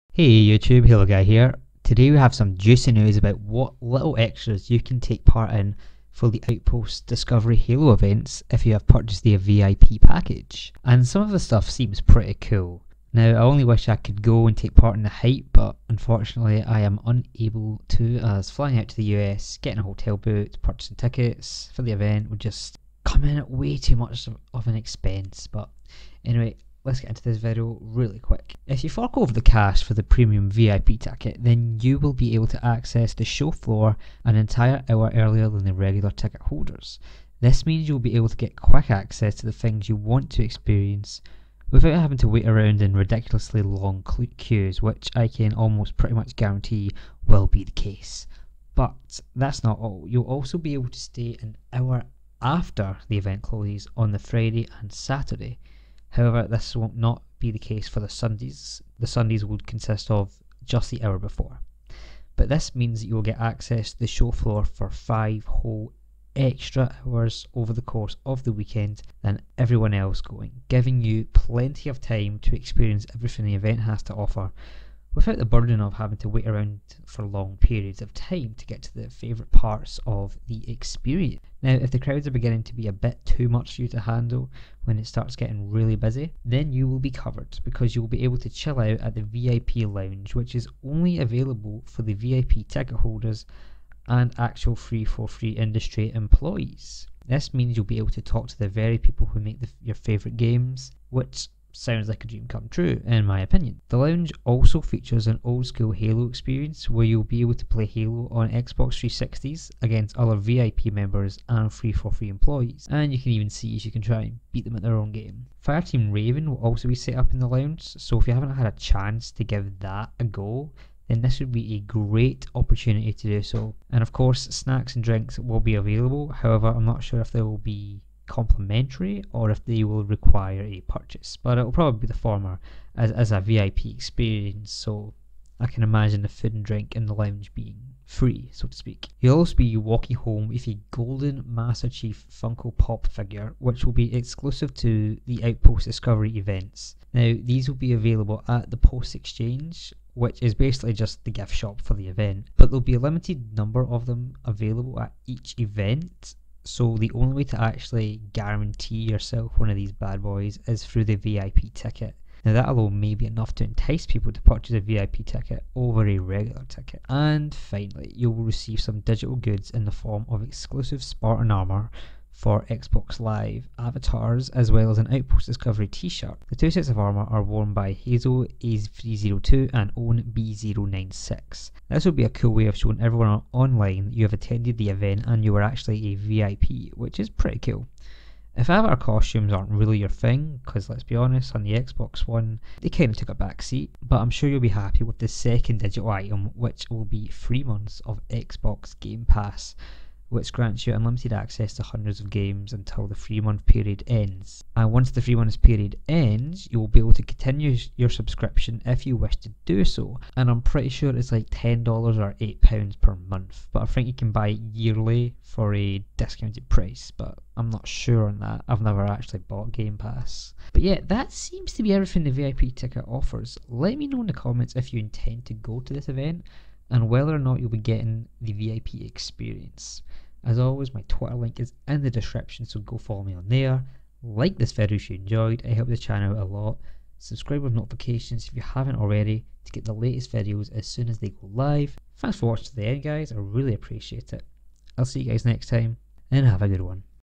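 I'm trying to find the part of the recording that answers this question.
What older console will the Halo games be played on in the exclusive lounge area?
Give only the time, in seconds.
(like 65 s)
108 s.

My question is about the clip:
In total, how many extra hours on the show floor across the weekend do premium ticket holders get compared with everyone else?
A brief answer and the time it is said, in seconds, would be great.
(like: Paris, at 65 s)
5, at 64 s.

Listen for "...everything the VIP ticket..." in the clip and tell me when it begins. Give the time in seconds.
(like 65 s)
221 s.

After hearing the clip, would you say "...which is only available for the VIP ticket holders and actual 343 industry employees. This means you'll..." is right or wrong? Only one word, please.
right.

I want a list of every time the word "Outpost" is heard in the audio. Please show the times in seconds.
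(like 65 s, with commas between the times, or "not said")
6 s, 145 s, 175 s.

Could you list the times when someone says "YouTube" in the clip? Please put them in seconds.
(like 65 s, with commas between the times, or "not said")
0 s.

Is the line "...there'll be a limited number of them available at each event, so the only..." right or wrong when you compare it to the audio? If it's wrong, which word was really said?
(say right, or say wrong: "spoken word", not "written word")
right.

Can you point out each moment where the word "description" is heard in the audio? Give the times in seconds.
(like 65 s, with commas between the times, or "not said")
232 s.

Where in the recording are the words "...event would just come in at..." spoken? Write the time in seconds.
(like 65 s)
21 s.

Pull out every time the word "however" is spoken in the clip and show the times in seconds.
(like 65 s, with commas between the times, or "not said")
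56 s, 126 s.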